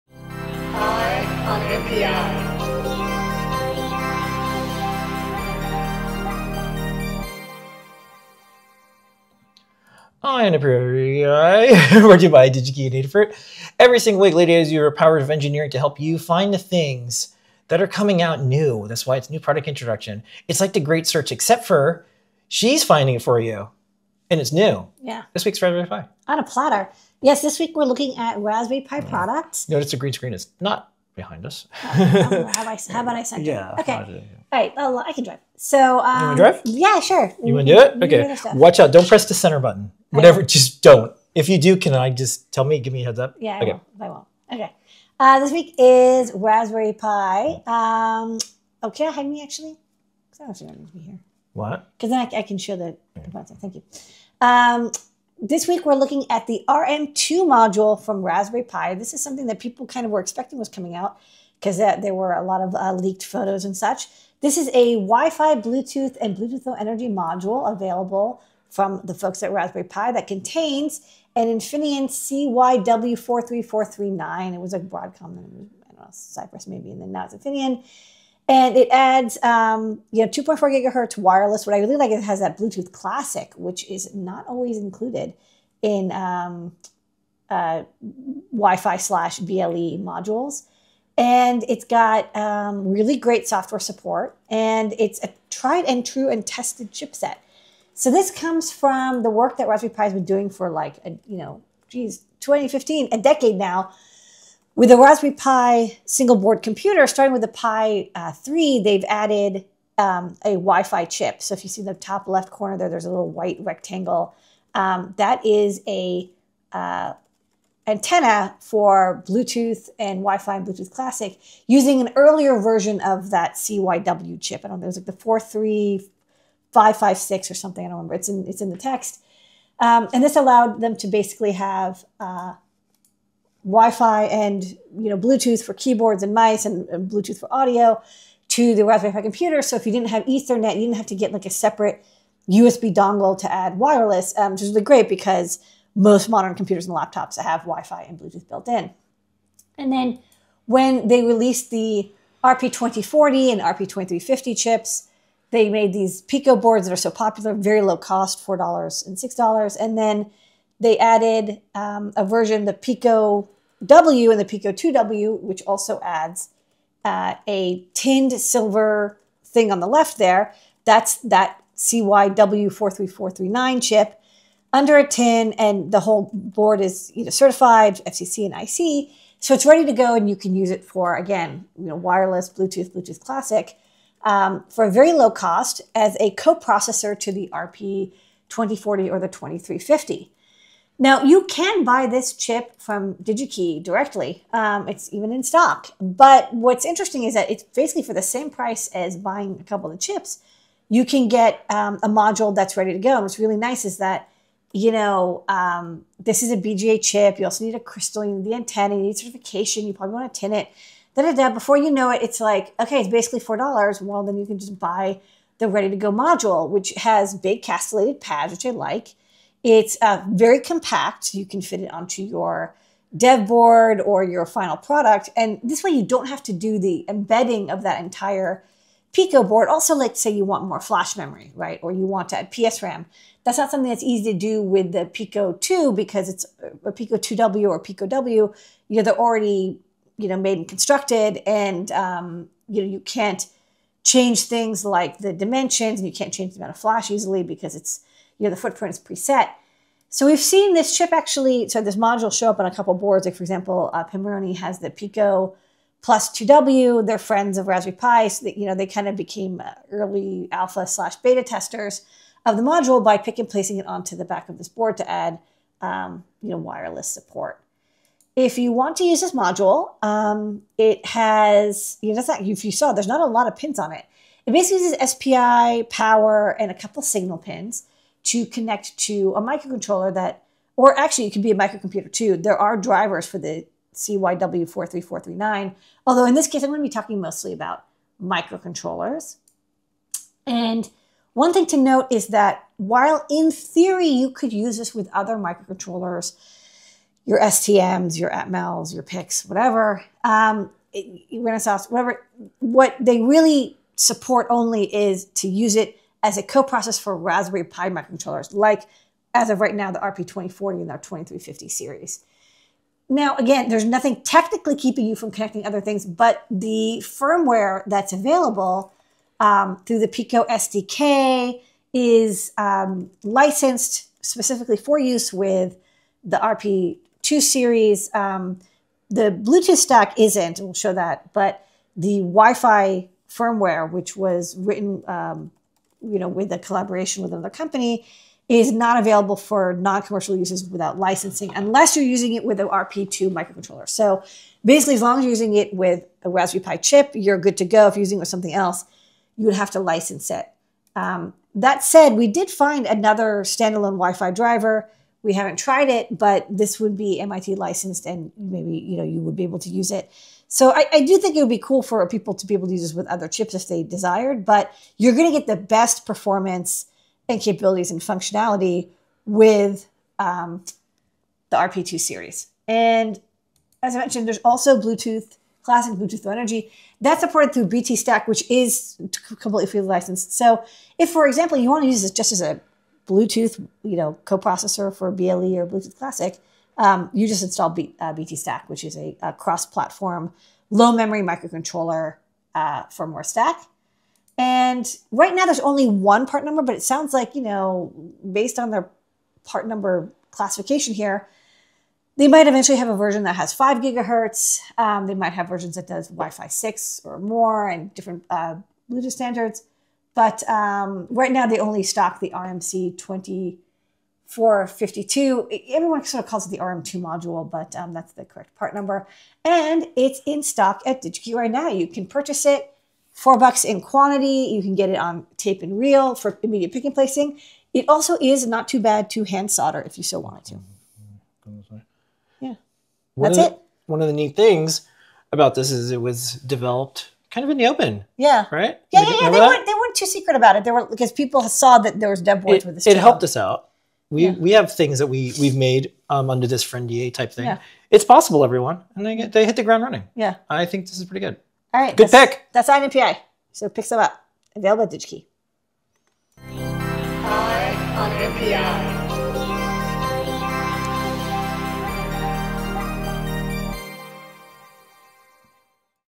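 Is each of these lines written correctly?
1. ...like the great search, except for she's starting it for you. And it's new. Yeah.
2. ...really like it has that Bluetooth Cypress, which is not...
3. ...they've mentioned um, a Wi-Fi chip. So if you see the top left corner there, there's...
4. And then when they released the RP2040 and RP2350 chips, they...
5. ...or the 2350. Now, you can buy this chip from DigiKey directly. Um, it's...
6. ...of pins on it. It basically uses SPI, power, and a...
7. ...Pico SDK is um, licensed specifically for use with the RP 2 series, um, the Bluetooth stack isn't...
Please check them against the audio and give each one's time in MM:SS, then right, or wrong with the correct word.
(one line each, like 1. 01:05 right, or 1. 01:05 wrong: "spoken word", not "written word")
1. 00:20 wrong: "finding", not "starting"
2. 01:21 wrong: "Classic", not "Cypress"
3. 01:48 wrong: "added", not "mentioned"
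4. 02:29 right
5. 03:09 right
6. 04:33 right
7. 05:20 right.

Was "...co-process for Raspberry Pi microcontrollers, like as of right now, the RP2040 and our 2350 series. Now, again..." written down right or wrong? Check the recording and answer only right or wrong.
right.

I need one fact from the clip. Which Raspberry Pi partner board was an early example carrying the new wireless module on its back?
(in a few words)
Pico plus 2W.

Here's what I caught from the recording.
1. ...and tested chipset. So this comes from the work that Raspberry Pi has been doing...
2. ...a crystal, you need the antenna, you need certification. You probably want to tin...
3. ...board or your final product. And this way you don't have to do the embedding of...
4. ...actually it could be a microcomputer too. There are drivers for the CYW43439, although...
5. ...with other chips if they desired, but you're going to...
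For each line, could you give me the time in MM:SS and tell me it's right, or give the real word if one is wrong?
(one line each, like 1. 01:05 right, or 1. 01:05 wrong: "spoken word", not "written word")
1. 01:36 right
2. 03:27 right
3. 03:43 right
4. 04:40 right
5. 06:02 right.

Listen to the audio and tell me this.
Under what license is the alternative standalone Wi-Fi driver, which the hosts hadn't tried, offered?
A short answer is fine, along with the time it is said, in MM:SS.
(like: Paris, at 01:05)
MIT, at 05:57.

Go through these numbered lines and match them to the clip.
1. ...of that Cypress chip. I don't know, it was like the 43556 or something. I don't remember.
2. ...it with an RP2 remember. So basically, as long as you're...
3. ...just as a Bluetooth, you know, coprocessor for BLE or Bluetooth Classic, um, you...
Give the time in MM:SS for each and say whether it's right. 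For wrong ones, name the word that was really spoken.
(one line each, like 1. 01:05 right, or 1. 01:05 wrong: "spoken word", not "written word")
1. 02:03 wrong: "CYW", not "Cypress"
2. 05:42 wrong: "microcontroller", not "remember"
3. 06:22 right.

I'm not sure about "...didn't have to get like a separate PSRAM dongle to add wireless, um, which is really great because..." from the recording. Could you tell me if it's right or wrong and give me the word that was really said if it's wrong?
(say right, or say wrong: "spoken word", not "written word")
wrong: "USB", not "PSRAM".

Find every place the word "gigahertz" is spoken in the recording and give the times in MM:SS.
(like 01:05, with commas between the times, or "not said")
01:20, 06:43.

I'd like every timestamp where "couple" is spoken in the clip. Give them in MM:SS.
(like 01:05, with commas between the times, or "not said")
03:19, 04:12, 04:36.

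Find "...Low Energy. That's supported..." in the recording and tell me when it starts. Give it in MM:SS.
06:16.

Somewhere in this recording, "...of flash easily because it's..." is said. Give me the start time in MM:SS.
04:06.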